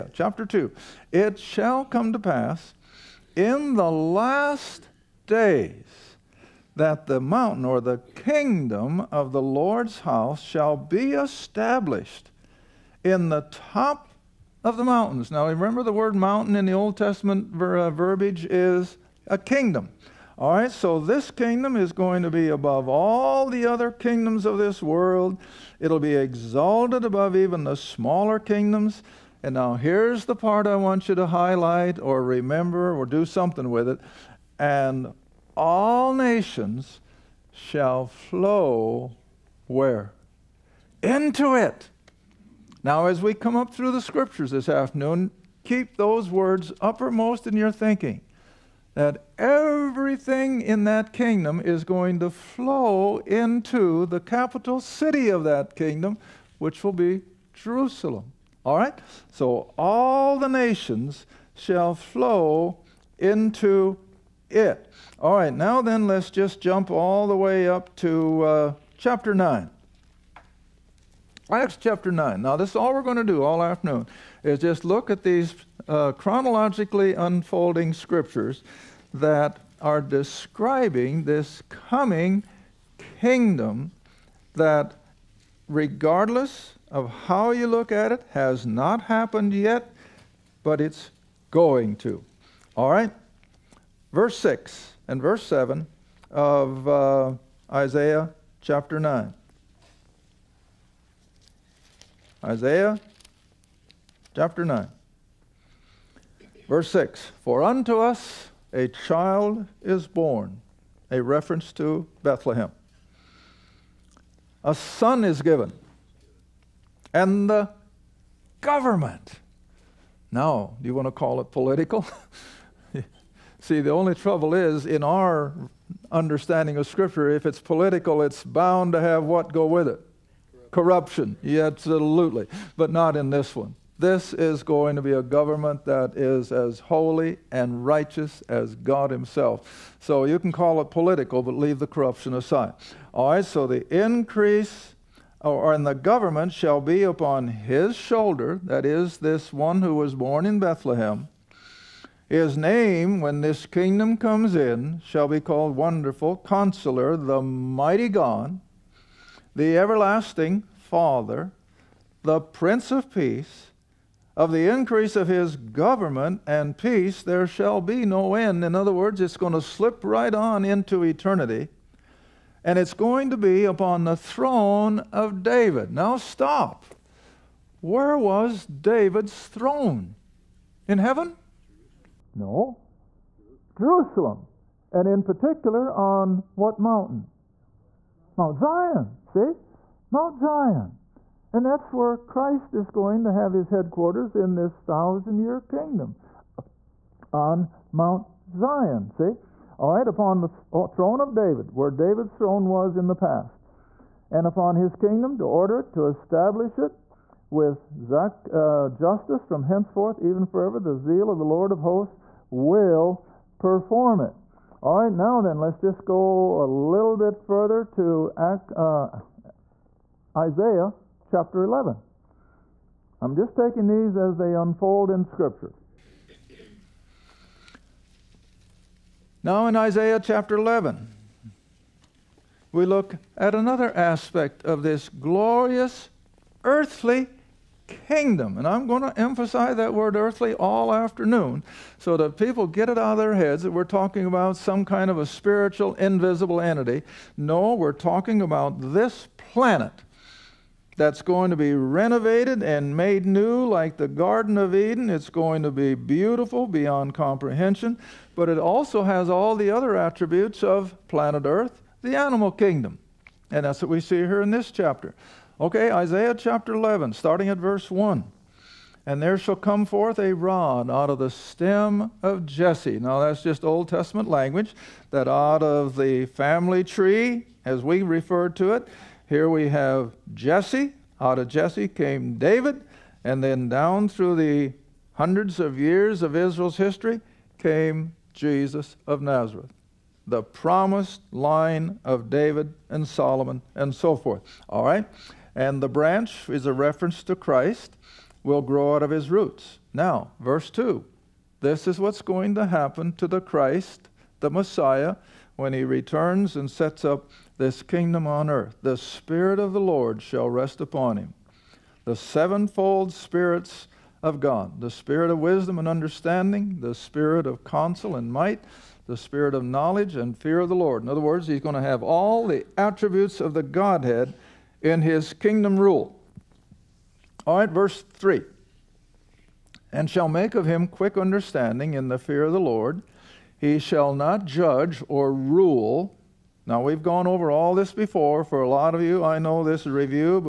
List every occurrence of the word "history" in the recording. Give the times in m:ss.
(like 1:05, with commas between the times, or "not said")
4:46.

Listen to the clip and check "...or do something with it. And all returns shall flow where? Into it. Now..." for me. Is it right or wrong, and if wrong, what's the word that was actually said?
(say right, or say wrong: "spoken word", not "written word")
wrong: "nations", not "returns".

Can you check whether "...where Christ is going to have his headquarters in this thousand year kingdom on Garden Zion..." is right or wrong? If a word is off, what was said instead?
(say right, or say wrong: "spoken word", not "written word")
wrong: "Mount", not "Garden".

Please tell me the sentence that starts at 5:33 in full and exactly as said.
He shall not judge or rule.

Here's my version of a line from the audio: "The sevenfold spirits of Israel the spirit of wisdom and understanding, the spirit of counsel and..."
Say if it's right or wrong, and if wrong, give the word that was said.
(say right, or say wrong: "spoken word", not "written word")
wrong: "God", not "Israel".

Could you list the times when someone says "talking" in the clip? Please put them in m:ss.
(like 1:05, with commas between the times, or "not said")
4:03, 4:07.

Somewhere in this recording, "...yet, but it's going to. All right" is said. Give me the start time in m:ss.
1:29.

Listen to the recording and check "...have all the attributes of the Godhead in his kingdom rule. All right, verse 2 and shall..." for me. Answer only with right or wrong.
wrong.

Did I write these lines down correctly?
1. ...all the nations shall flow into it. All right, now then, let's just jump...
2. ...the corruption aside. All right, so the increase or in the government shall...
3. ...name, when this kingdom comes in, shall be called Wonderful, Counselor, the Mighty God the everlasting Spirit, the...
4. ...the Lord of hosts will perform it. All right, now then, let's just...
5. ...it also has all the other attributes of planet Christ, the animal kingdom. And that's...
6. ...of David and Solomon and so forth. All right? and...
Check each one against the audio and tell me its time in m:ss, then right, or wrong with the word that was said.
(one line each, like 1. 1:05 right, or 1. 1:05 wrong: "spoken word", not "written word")
1. 0:59 right
2. 2:21 right
3. 2:32 wrong: "Father", not "Spirit"
4. 3:31 right
5. 4:18 wrong: "Earth", not "Christ"
6. 4:52 right.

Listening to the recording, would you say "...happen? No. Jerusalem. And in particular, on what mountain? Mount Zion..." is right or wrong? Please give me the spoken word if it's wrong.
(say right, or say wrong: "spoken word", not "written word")
wrong: "heaven", not "happen".